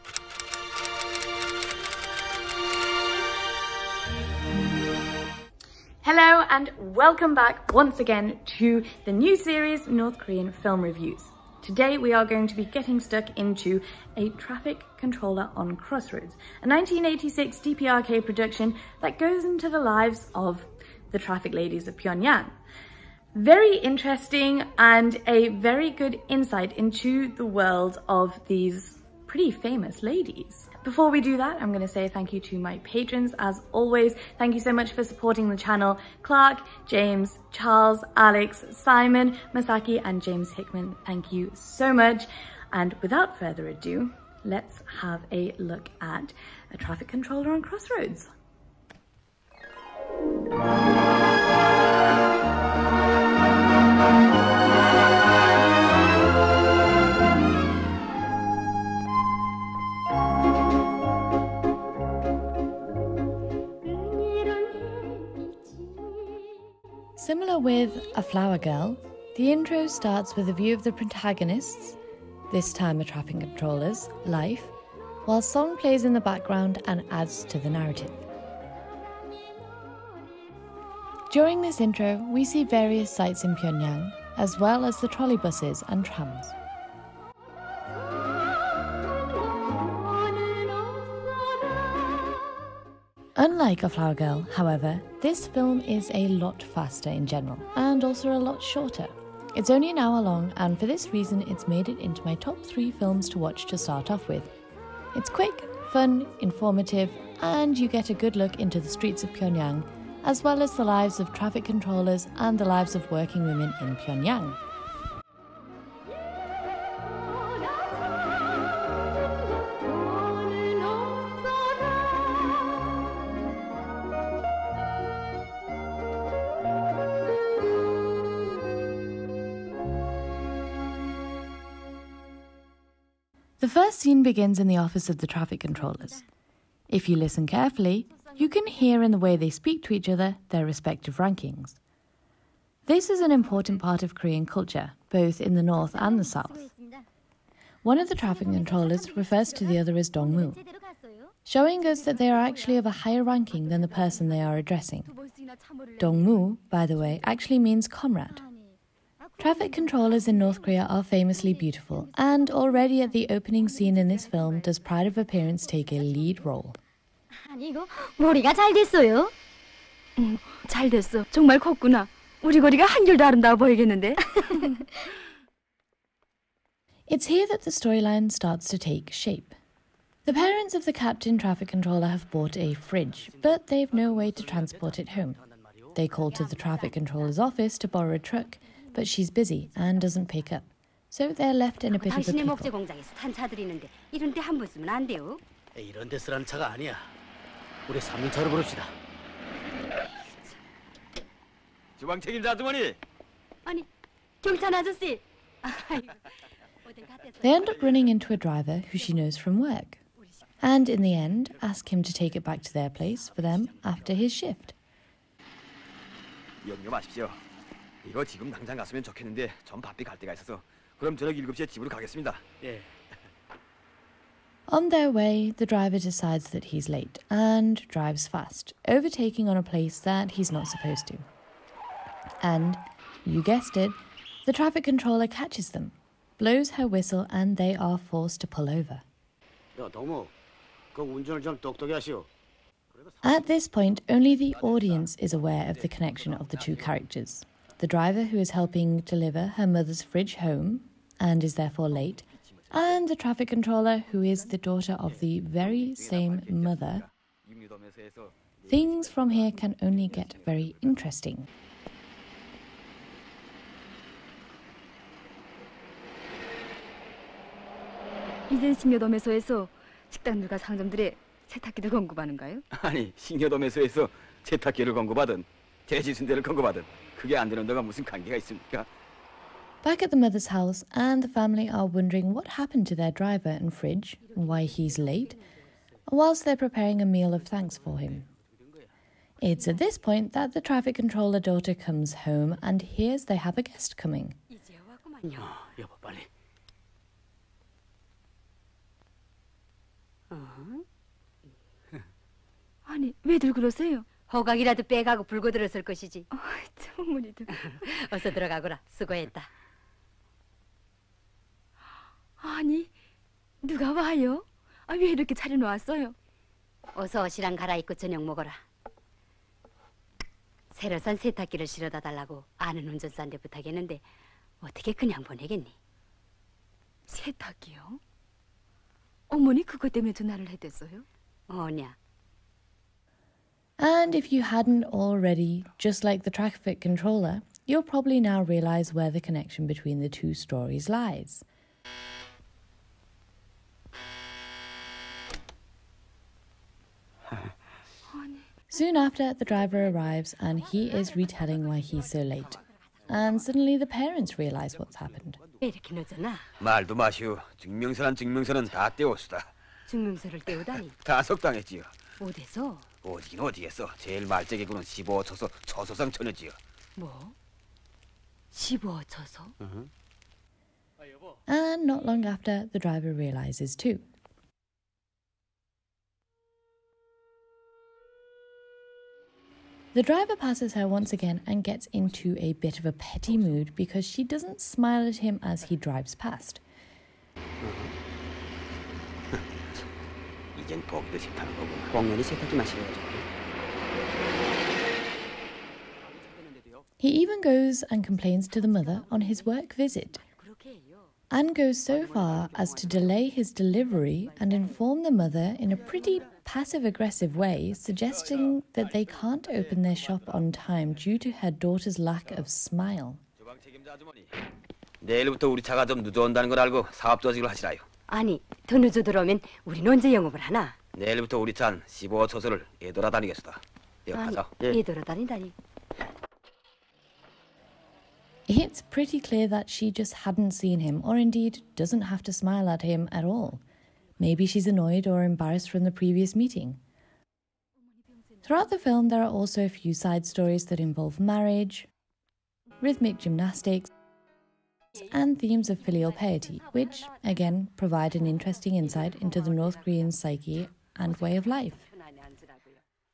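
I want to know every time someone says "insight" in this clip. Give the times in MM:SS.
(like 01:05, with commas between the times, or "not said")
00:26, 07:28.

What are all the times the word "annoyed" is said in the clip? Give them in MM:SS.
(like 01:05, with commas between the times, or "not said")
07:14.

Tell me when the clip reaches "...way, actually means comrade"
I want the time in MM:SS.
02:36.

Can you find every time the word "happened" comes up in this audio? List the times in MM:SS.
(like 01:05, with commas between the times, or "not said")
04:42, 05:54.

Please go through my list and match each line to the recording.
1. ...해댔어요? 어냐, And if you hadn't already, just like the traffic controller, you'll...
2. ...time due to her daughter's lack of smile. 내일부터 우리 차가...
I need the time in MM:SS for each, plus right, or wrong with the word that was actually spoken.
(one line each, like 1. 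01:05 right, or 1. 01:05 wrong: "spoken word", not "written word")
1. 05:30 right
2. 06:50 right.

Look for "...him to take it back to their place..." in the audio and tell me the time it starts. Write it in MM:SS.
03:31.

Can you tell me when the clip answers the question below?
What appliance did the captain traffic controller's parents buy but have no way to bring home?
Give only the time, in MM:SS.
03:02.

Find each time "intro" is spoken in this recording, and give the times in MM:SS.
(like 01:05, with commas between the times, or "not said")
01:09, 01:21.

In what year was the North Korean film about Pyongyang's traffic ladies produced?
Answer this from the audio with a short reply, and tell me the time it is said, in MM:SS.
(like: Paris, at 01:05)
1986, at 00:16.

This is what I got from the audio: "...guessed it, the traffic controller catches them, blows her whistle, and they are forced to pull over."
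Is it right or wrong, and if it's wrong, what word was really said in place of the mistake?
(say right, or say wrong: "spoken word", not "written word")
right.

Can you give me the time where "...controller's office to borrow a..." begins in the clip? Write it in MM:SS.
03:06.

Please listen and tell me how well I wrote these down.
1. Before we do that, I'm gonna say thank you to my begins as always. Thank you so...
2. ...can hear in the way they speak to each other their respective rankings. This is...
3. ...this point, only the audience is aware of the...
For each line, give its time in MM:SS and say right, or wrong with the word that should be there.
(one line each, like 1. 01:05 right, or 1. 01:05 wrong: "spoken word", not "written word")
1. 00:30 wrong: "patrons", not "begins"
2. 02:18 right
3. 04:03 right.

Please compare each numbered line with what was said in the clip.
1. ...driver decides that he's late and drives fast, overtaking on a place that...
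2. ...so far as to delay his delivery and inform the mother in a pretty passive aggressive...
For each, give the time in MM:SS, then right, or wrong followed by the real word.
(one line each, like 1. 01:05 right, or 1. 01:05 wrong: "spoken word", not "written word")
1. 03:45 right
2. 06:41 right.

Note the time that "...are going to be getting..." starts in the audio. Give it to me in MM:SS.
00:12.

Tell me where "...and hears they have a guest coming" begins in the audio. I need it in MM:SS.
04:52.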